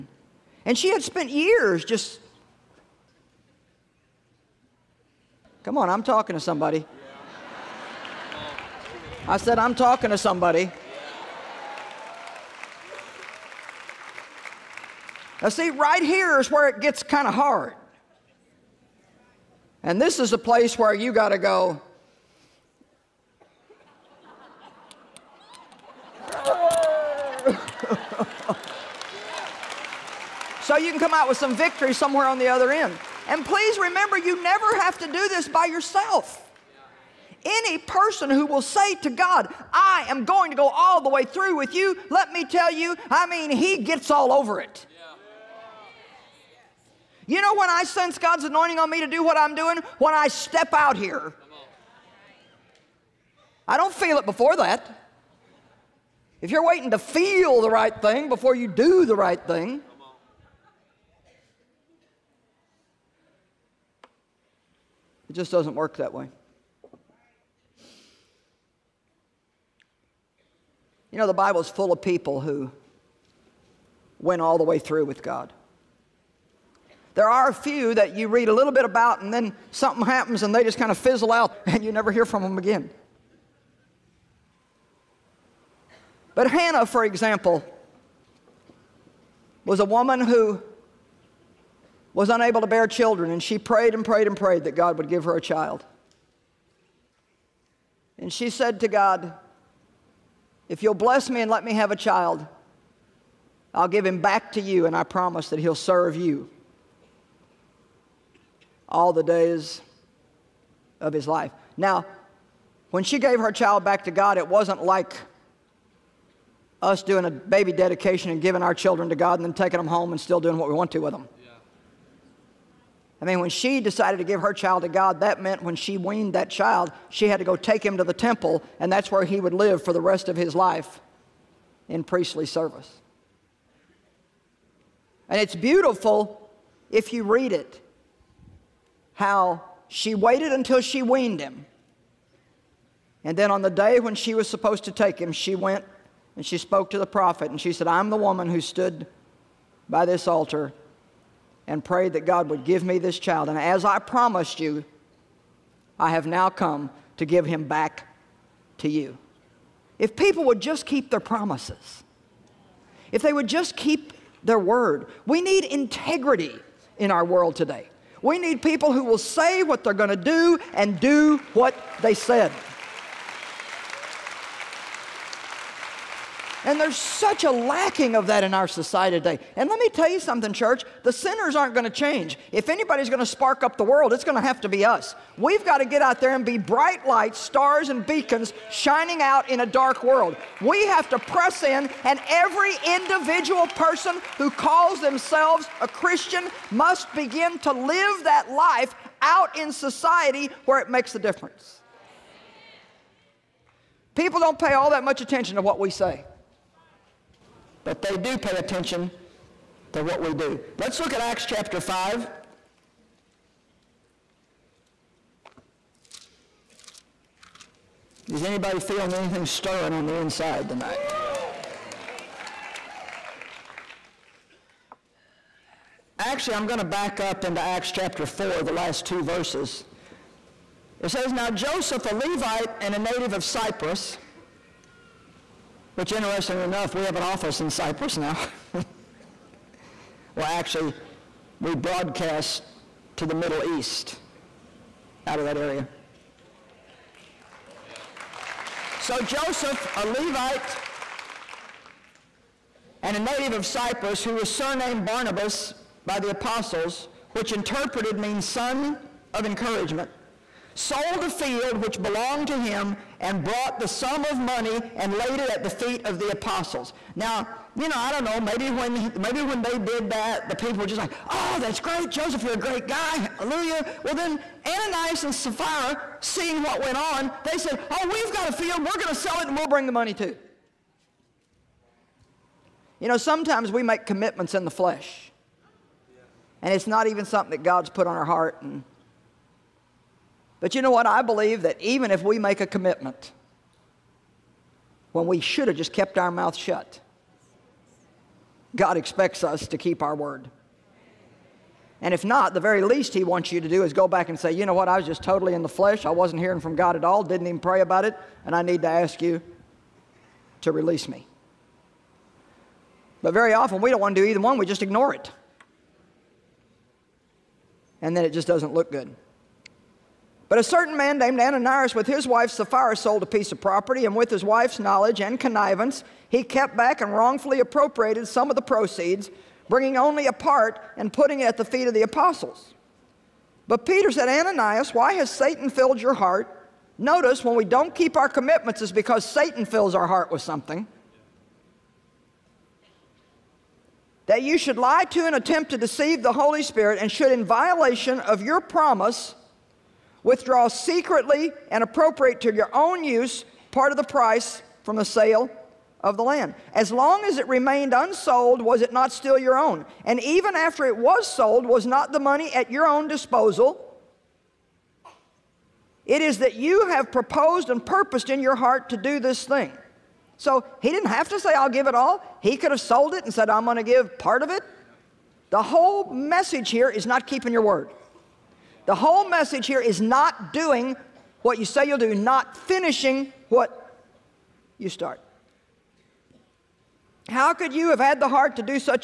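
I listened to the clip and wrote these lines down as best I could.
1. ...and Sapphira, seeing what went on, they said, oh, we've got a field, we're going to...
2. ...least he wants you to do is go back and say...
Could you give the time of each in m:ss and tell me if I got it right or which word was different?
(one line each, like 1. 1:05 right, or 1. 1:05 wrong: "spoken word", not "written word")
1. 4:35 right
2. 5:02 right.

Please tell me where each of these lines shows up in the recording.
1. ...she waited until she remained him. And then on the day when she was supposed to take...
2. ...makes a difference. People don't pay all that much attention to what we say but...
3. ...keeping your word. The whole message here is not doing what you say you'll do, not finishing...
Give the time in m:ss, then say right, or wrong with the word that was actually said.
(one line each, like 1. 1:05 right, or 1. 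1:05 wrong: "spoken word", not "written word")
1. 2:19 wrong: "weaned", not "remained"
2. 3:20 right
3. 6:17 right.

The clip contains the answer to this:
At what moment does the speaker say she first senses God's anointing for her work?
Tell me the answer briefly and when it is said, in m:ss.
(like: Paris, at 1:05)
When I step out here, at 0:49.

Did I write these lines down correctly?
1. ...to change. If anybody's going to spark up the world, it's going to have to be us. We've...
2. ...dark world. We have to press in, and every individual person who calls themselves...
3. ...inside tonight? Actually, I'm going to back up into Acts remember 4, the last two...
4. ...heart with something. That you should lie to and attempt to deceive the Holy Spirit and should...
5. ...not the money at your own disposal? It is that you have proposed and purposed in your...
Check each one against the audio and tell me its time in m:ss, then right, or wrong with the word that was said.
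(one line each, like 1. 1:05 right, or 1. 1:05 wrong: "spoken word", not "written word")
1. 3:01 right
2. 3:09 right
3. 3:40 wrong: "chapter", not "remember"
4. 5:40 right
5. 6:01 right.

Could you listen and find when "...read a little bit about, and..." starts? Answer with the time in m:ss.
1:18.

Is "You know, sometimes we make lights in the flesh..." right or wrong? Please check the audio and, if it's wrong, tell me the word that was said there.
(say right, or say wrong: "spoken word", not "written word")
wrong: "commitments", not "lights".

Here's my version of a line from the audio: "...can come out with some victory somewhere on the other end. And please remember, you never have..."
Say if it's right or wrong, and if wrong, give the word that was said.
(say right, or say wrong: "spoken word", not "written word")
right.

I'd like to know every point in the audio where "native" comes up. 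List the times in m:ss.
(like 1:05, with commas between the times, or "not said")
3:52, 4:13.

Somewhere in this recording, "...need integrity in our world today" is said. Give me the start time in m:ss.
2:45.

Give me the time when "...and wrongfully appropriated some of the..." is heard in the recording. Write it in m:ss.
5:26.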